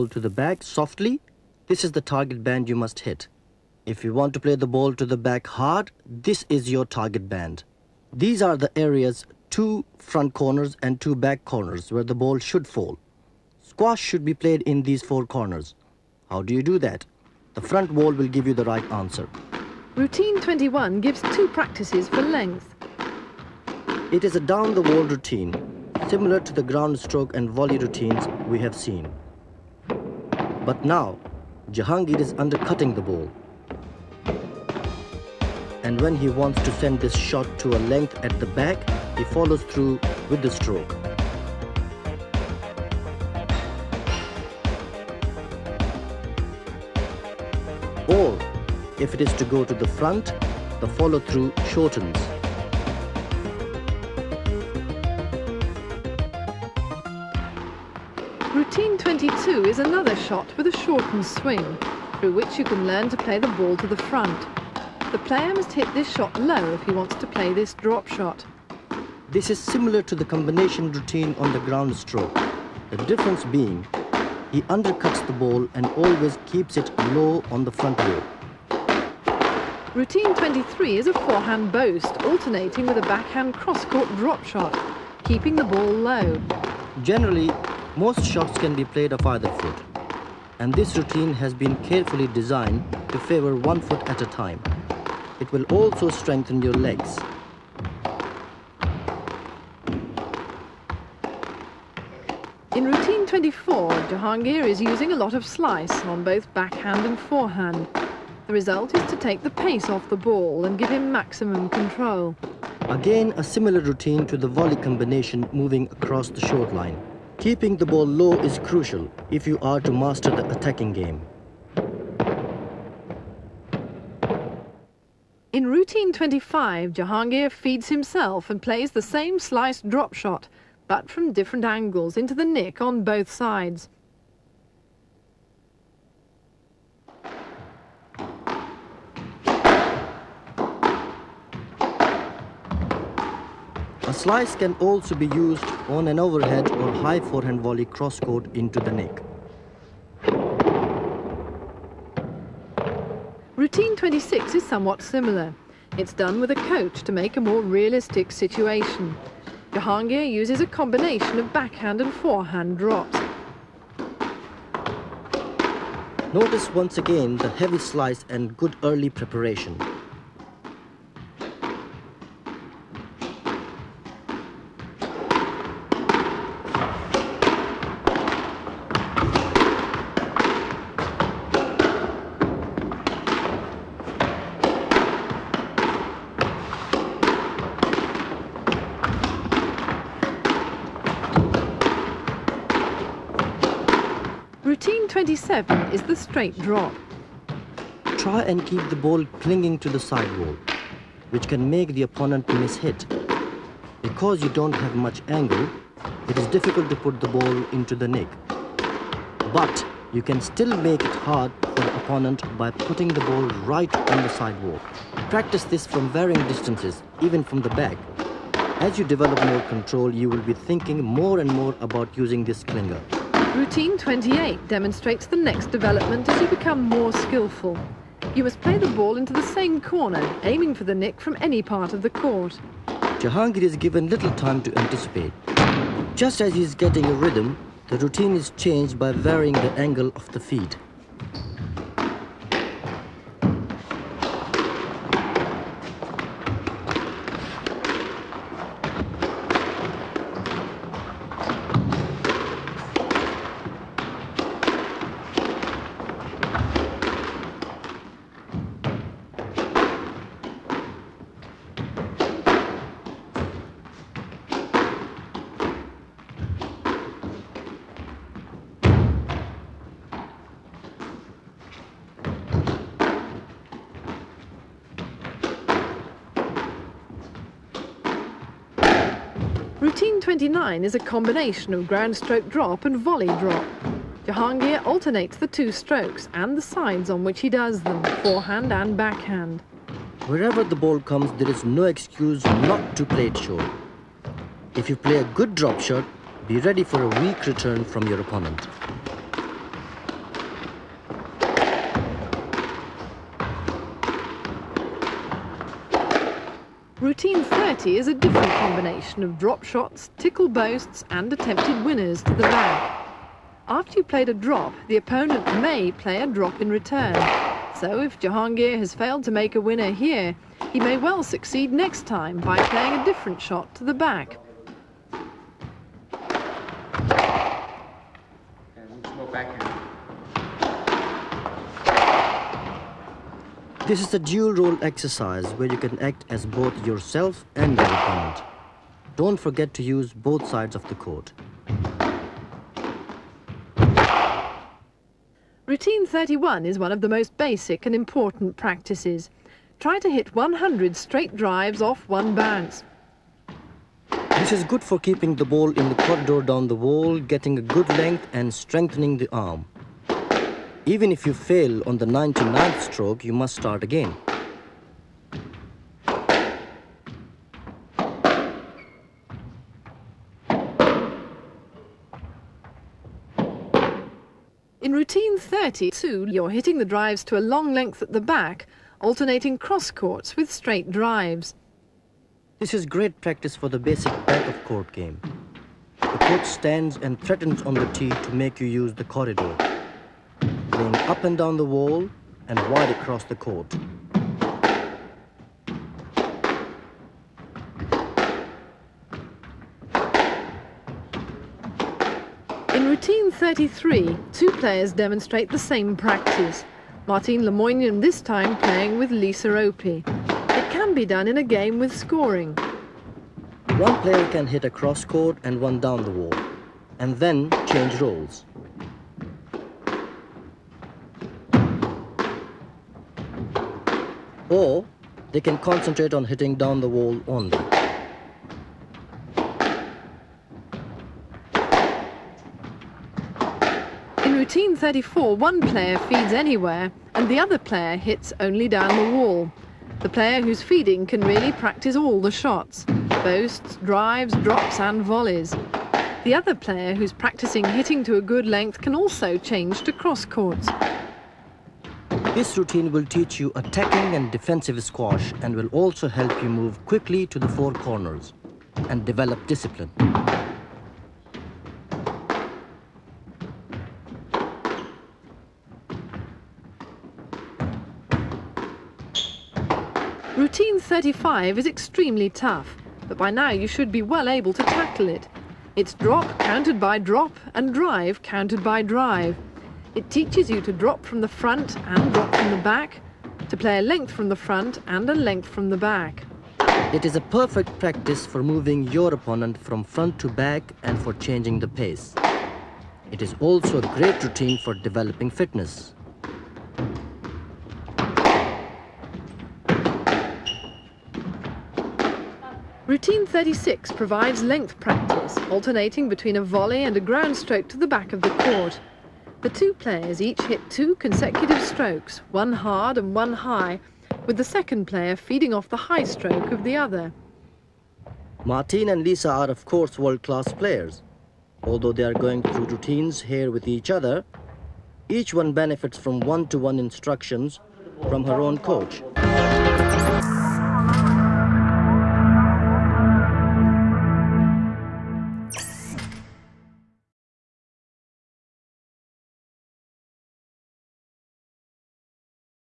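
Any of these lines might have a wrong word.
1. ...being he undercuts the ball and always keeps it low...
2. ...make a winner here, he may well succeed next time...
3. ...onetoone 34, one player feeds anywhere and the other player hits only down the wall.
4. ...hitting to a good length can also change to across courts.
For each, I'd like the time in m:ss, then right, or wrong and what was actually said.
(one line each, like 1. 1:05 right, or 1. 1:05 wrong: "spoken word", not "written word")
1. 1:13 right
2. 5:19 right
3. 7:14 wrong: "routine", not "onetoone"
4. 7:27 wrong: "cross", not "across".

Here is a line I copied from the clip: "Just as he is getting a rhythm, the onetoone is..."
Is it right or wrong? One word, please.
wrong.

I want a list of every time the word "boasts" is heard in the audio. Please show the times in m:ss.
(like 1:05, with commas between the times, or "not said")
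1:21, 5:10, 7:23.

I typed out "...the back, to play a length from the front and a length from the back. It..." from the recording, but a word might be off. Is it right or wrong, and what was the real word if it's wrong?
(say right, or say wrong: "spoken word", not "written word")
right.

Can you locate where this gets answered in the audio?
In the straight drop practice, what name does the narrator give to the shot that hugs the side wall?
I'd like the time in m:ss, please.
3:42.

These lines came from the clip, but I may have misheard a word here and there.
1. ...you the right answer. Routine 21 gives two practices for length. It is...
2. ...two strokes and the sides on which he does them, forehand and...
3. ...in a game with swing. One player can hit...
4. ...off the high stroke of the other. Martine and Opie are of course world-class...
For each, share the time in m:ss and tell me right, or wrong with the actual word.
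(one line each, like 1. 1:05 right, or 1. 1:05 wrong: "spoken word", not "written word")
1. 0:18 right
2. 4:45 right
3. 6:51 wrong: "scoring", not "swing"
4. 8:35 wrong: "Lisa", not "Opie".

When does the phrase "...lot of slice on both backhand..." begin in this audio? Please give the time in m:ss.
1:45.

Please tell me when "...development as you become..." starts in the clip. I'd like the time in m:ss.
3:45.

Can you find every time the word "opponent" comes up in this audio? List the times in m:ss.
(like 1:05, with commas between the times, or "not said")
3:22, 3:31, 4:58, 5:14, 5:37, 8:09.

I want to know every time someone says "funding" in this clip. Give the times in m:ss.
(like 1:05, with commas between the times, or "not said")
not said.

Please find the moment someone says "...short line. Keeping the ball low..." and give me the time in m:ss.
1:56.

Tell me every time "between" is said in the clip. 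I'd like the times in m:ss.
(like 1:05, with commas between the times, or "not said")
8:26.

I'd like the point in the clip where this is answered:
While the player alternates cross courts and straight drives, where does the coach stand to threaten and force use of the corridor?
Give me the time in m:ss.
6:27.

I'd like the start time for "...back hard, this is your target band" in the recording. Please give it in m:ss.
0:05.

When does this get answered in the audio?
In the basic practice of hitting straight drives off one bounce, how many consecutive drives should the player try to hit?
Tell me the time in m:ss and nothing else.
5:50.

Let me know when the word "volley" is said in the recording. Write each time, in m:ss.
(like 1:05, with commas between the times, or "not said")
0:27, 1:54, 2:27, 4:42, 7:25, 8:26.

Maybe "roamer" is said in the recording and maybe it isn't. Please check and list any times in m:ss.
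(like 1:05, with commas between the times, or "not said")
not said.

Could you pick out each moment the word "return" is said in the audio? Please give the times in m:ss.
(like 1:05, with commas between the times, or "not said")
4:57, 5:16.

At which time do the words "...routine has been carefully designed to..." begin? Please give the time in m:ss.
1:30.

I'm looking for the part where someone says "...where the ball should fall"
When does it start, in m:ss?
0:11.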